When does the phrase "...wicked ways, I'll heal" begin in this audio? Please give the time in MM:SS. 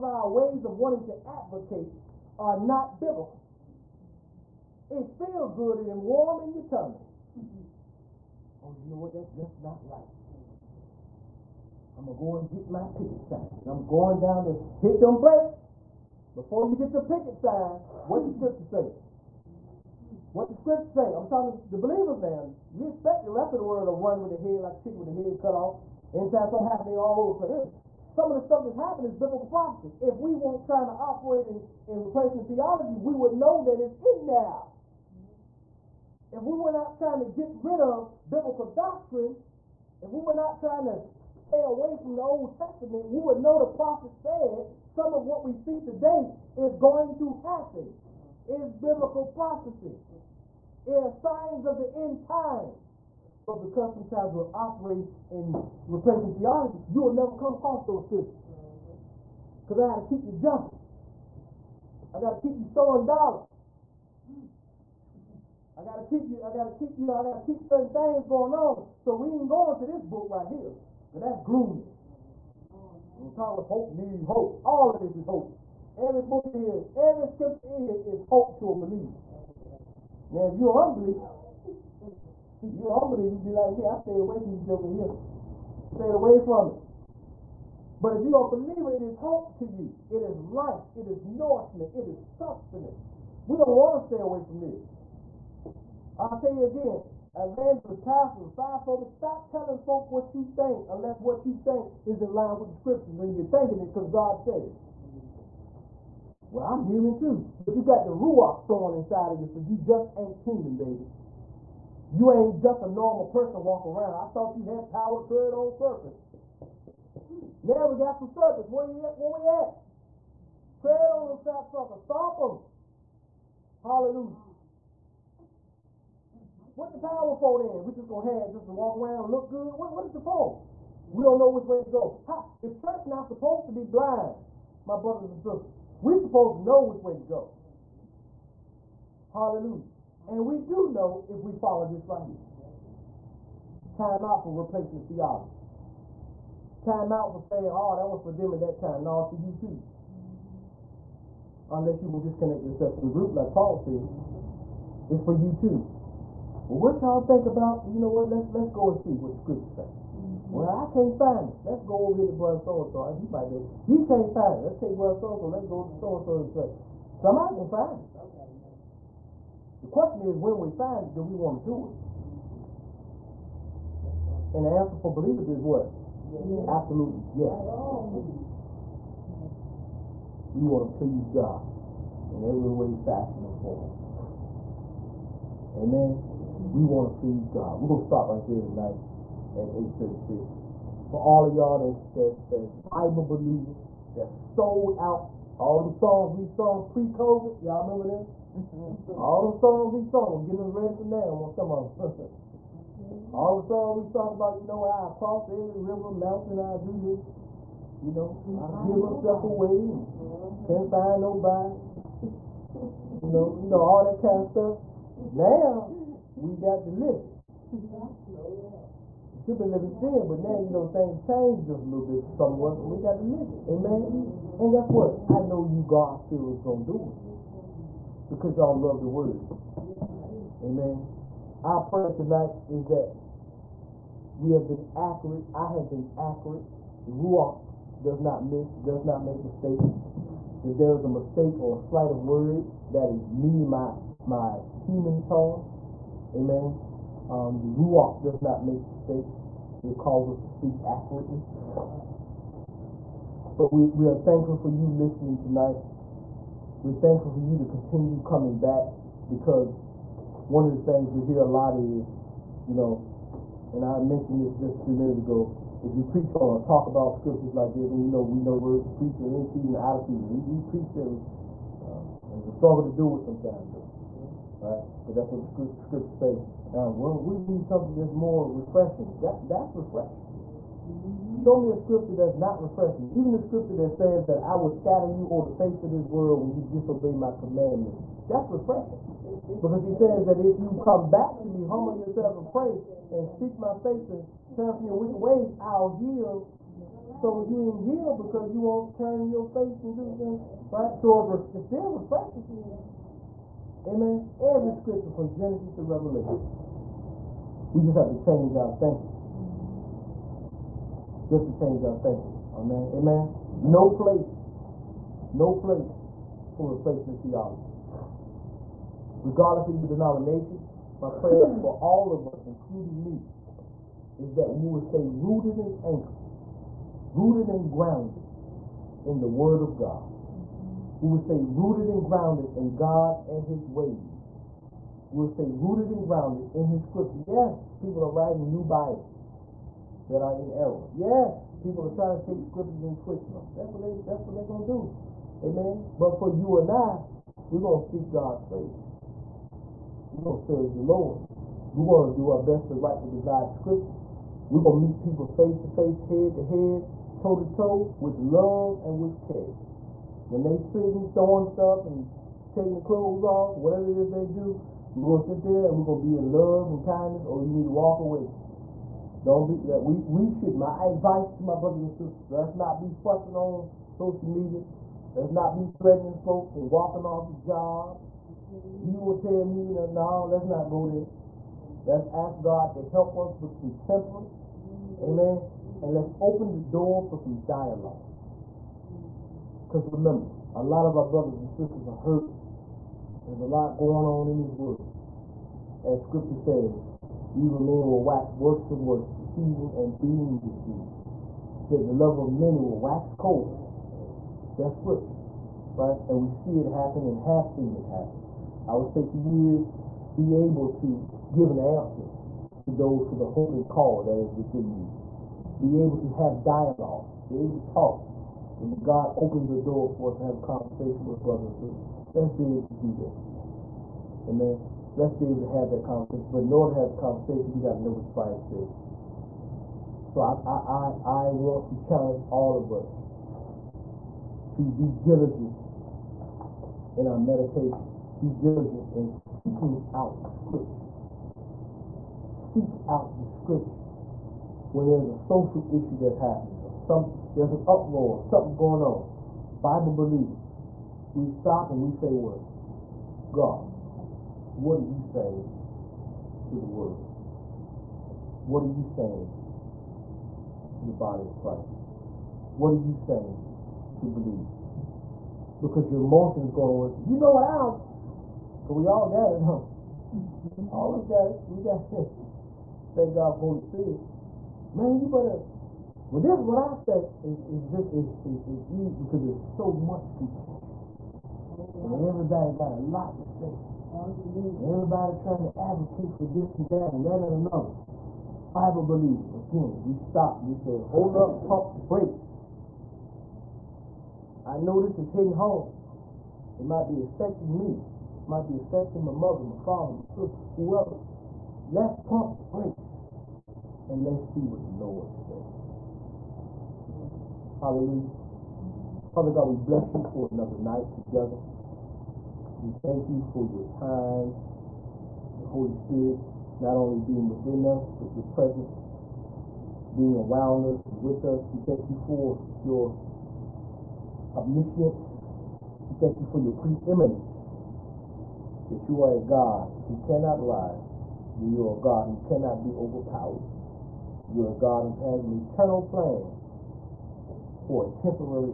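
04:54.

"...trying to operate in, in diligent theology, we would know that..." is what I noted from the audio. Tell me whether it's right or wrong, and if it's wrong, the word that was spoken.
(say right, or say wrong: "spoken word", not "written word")
wrong: "replacement", not "diligent".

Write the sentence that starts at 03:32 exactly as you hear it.
You know, you know all that kind of stuff.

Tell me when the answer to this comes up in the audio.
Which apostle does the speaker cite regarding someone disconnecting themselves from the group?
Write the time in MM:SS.
02:33.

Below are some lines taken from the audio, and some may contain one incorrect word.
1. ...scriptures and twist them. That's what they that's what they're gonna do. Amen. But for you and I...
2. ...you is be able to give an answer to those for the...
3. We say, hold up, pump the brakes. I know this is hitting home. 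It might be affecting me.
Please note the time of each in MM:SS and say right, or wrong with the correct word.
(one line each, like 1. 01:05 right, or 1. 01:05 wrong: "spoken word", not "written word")
1. 05:42 right
2. 06:49 right
3. 08:10 right.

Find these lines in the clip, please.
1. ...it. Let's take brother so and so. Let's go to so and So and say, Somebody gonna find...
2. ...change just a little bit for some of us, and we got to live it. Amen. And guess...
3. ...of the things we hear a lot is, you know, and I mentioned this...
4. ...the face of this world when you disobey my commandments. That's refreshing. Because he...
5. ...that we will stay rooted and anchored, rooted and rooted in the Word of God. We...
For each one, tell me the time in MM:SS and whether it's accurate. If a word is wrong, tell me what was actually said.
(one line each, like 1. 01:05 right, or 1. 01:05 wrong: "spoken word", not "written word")
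1. 02:44 right
2. 03:41 right
3. 04:20 right
4. 04:45 right
5. 05:24 wrong: "grounded", not "rooted".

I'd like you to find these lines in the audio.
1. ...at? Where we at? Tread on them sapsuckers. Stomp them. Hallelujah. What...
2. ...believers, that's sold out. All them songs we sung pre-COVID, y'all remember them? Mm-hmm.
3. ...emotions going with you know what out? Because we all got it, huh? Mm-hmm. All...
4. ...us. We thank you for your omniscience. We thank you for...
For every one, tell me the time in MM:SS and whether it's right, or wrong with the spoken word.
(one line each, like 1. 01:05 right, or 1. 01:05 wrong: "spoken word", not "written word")
1. 01:59 right
2. 03:13 right
3. 07:46 right
4. 08:41 right.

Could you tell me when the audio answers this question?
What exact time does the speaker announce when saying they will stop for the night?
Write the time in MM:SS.
03:09.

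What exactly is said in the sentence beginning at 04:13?
But we, we are thankful for you listening tonight.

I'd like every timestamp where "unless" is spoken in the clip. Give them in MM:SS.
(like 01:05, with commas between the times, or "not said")
01:40, 02:31.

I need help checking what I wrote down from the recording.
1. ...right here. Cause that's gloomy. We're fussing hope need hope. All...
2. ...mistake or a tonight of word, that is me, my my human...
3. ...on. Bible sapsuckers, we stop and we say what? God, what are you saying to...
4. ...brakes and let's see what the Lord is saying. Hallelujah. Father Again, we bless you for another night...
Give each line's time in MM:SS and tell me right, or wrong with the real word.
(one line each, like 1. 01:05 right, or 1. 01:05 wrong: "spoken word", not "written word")
1. 01:10 wrong: "talking", not "fussing"
2. 04:01 wrong: "slight", not "tonight"
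3. 07:28 wrong: "believers", not "sapsuckers"
4. 08:22 wrong: "God", not "Again".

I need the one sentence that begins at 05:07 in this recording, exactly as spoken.
We just have to change our thinking.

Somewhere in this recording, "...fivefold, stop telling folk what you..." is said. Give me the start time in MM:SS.
01:38.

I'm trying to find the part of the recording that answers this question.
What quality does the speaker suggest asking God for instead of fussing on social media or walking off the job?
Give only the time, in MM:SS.
06:23.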